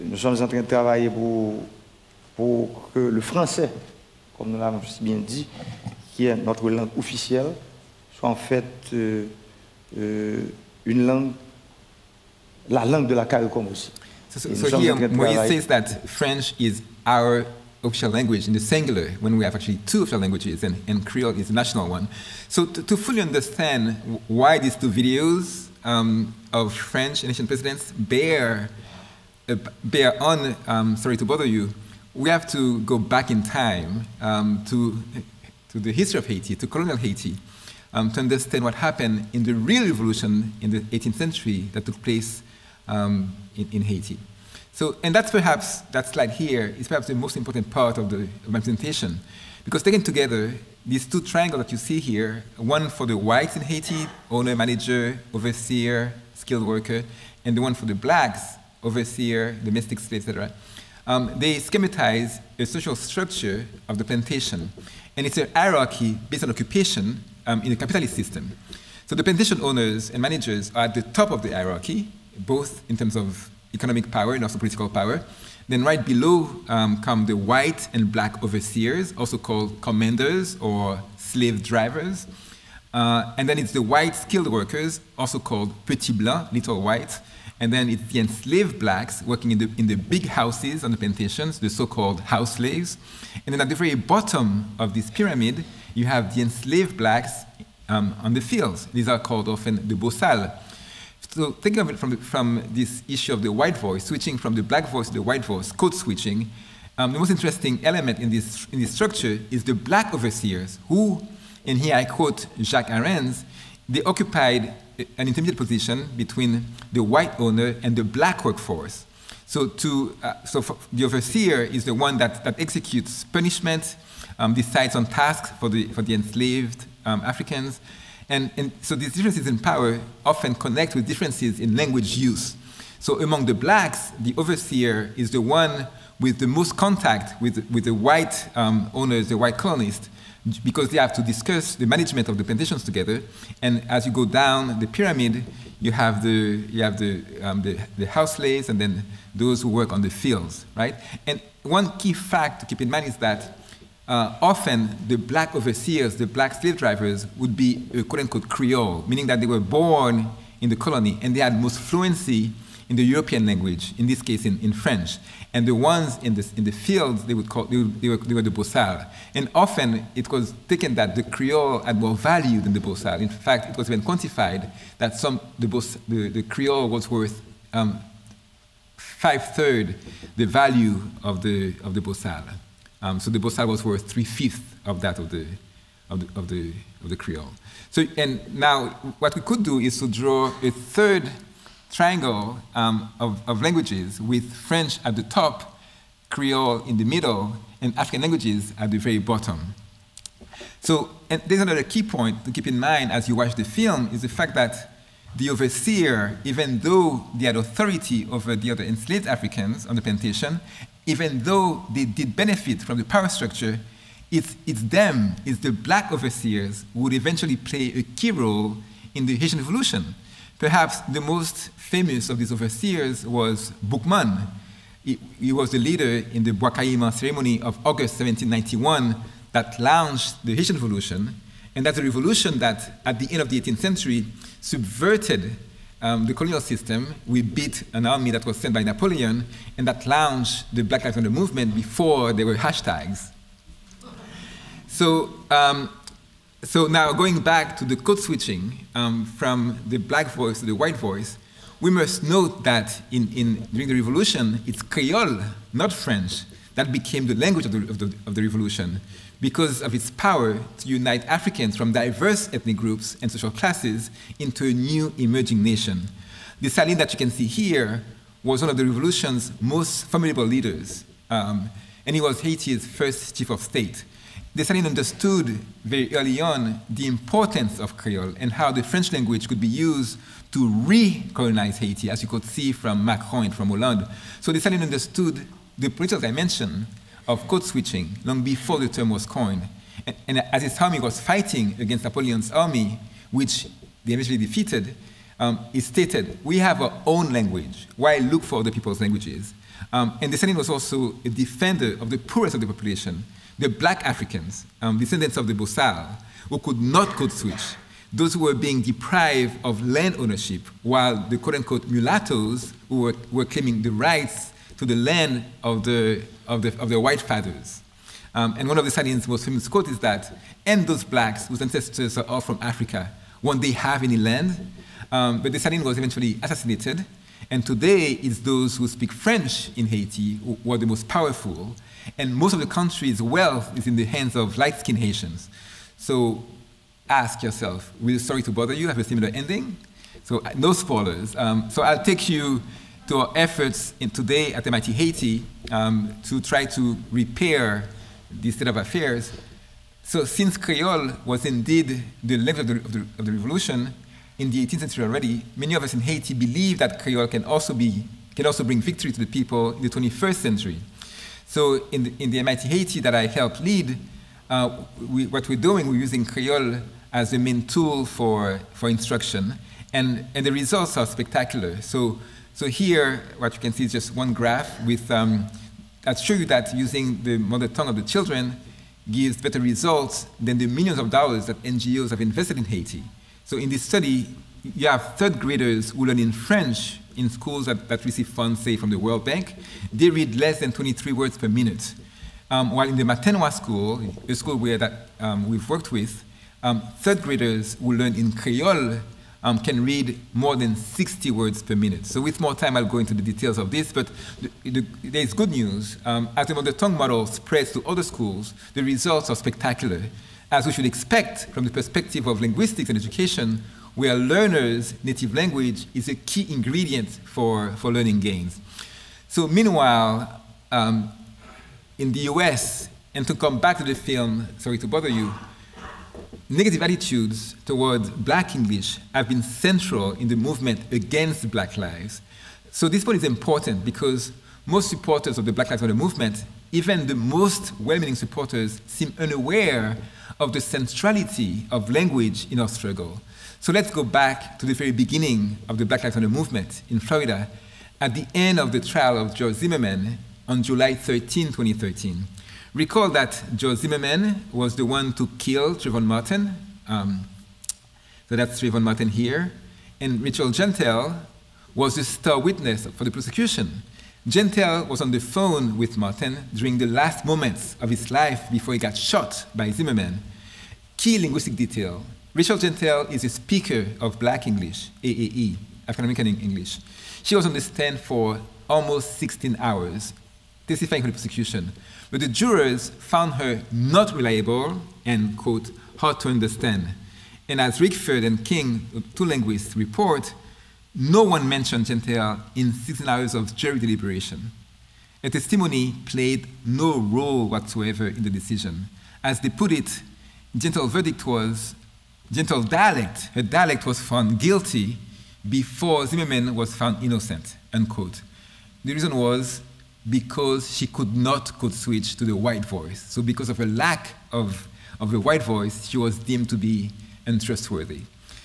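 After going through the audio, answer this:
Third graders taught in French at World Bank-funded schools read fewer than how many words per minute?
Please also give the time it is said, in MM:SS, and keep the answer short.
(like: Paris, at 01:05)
23, at 06:30.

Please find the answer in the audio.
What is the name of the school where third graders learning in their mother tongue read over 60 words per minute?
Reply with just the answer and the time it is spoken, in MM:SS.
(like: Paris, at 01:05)
Matenwa, at 06:33.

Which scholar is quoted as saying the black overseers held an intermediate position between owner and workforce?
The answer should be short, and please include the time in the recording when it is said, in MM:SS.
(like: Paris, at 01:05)
Jacques Arens, at 01:52.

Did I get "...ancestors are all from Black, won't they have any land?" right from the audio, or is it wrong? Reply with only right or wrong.
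wrong.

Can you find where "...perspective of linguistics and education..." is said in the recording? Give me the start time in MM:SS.
06:51.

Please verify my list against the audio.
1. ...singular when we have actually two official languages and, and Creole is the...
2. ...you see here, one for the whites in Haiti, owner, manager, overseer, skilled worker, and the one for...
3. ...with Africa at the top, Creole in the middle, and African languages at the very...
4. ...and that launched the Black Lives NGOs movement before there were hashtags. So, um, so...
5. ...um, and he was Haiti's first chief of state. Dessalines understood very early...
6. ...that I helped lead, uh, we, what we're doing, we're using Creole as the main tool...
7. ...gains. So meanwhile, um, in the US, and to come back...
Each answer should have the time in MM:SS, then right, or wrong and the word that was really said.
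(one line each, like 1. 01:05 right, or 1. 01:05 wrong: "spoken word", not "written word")
1. 00:18 right
2. 00:51 right
3. 03:14 wrong: "French", not "Africa"
4. 03:59 wrong: "Matter", not "NGOs"
5. 04:31 right
6. 06:03 right
7. 06:58 right.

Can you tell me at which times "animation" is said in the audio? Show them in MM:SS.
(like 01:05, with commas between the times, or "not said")
not said.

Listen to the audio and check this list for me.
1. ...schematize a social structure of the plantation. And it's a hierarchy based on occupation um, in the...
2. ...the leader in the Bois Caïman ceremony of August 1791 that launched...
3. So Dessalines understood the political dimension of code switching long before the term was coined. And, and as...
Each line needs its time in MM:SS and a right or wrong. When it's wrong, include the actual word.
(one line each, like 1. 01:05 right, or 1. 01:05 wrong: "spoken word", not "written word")
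1. 01:01 right
2. 03:45 right
3. 04:44 right.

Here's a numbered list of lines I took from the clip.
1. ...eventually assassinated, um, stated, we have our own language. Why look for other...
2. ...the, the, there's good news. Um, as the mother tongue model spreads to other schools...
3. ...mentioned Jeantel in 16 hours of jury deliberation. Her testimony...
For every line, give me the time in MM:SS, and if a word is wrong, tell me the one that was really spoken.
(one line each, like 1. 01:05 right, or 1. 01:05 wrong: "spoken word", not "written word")
1. 04:54 wrong: "defeated", not "assassinated"
2. 06:44 right
3. 08:11 right.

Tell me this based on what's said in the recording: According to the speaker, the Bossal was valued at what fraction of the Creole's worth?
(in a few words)
3/5.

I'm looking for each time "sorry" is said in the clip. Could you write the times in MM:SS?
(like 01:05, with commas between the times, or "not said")
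00:30, 05:38, 07:04.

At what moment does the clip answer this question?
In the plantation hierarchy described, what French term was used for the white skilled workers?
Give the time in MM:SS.
01:25.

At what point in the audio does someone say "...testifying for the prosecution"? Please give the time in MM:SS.
08:00.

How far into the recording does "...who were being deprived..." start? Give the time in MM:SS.
05:08.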